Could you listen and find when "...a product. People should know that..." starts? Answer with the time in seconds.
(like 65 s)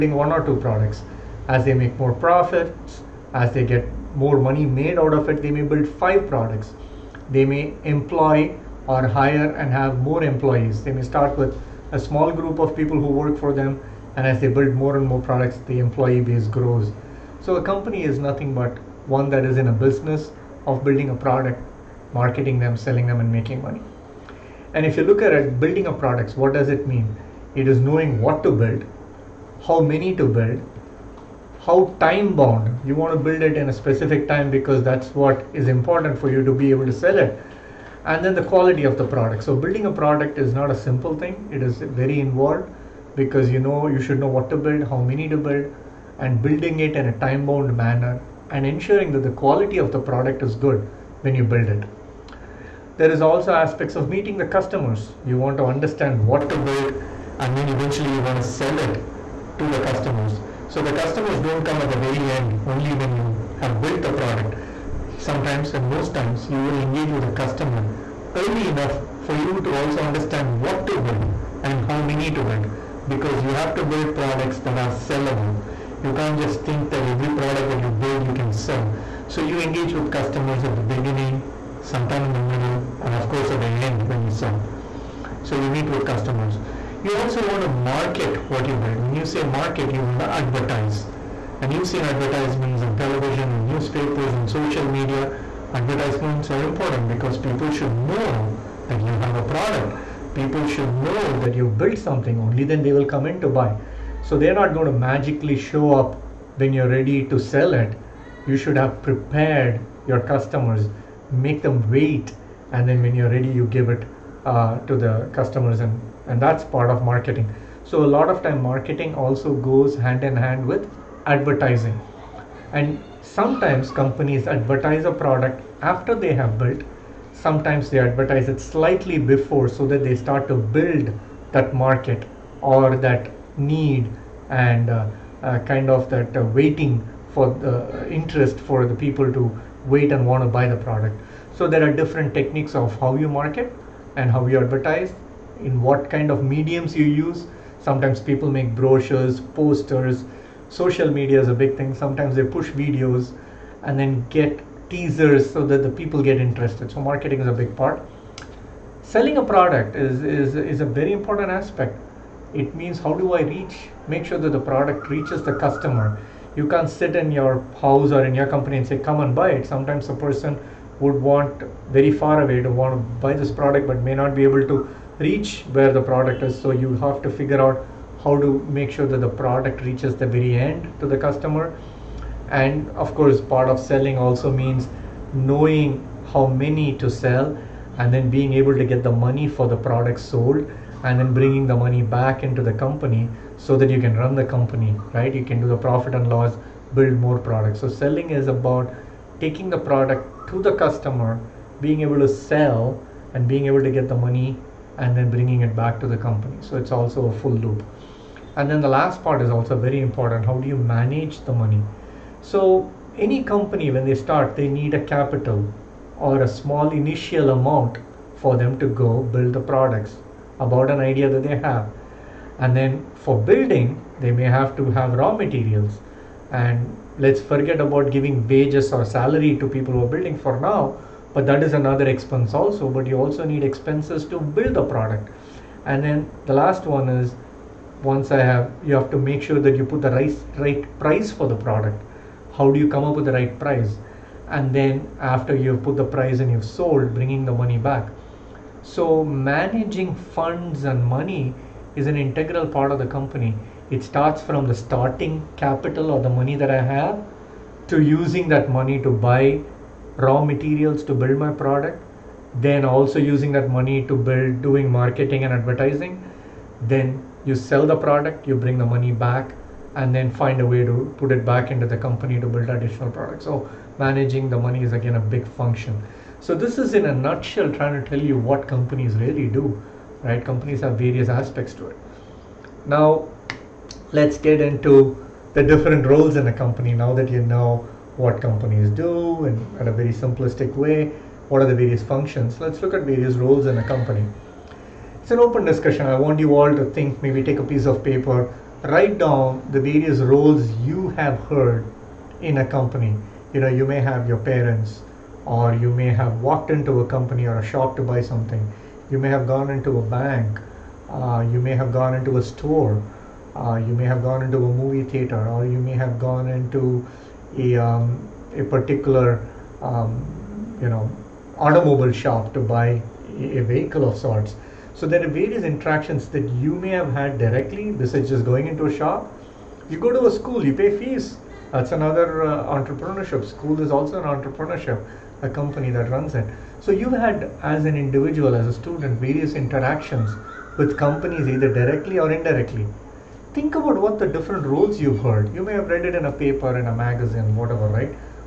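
99 s.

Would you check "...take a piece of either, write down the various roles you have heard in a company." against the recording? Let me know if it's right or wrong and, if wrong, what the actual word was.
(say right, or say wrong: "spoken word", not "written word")
wrong: "paper", not "either".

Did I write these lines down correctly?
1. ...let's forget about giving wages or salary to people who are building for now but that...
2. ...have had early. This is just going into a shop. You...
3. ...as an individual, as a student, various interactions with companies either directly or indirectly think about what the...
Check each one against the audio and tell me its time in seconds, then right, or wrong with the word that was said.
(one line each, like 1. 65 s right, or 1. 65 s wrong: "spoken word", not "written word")
1. 227 s right
2. 326 s wrong: "directly", not "early"
3. 337 s right.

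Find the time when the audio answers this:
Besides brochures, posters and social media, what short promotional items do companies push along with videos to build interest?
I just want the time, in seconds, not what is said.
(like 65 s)
154 s.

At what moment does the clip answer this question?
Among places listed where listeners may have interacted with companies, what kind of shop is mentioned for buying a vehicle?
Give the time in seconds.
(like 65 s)
321 s.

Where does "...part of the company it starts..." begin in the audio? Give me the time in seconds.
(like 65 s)
252 s.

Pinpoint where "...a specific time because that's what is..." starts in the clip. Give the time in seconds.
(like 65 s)
33 s.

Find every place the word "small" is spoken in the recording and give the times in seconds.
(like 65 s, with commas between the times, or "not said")
11 s, 216 s.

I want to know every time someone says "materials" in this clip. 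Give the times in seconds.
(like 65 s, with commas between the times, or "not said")
225 s, 260 s.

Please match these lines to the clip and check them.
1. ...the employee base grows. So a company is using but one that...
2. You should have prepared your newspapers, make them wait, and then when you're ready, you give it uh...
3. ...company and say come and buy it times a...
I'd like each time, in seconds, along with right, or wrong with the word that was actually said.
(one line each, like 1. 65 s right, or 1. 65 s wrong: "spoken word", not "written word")
1. 15 s wrong: "nothing", not "using"
2. 108 s wrong: "customers", not "newspapers"
3. 168 s wrong: "sometimes", not "times".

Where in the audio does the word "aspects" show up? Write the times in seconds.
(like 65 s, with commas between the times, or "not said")
53 s, 161 s, 281 s.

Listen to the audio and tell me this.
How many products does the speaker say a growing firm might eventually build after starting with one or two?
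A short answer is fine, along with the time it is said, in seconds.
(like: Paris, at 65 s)
5, at 5 s.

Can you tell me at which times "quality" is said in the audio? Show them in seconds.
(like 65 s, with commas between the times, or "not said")
38 s, 49 s.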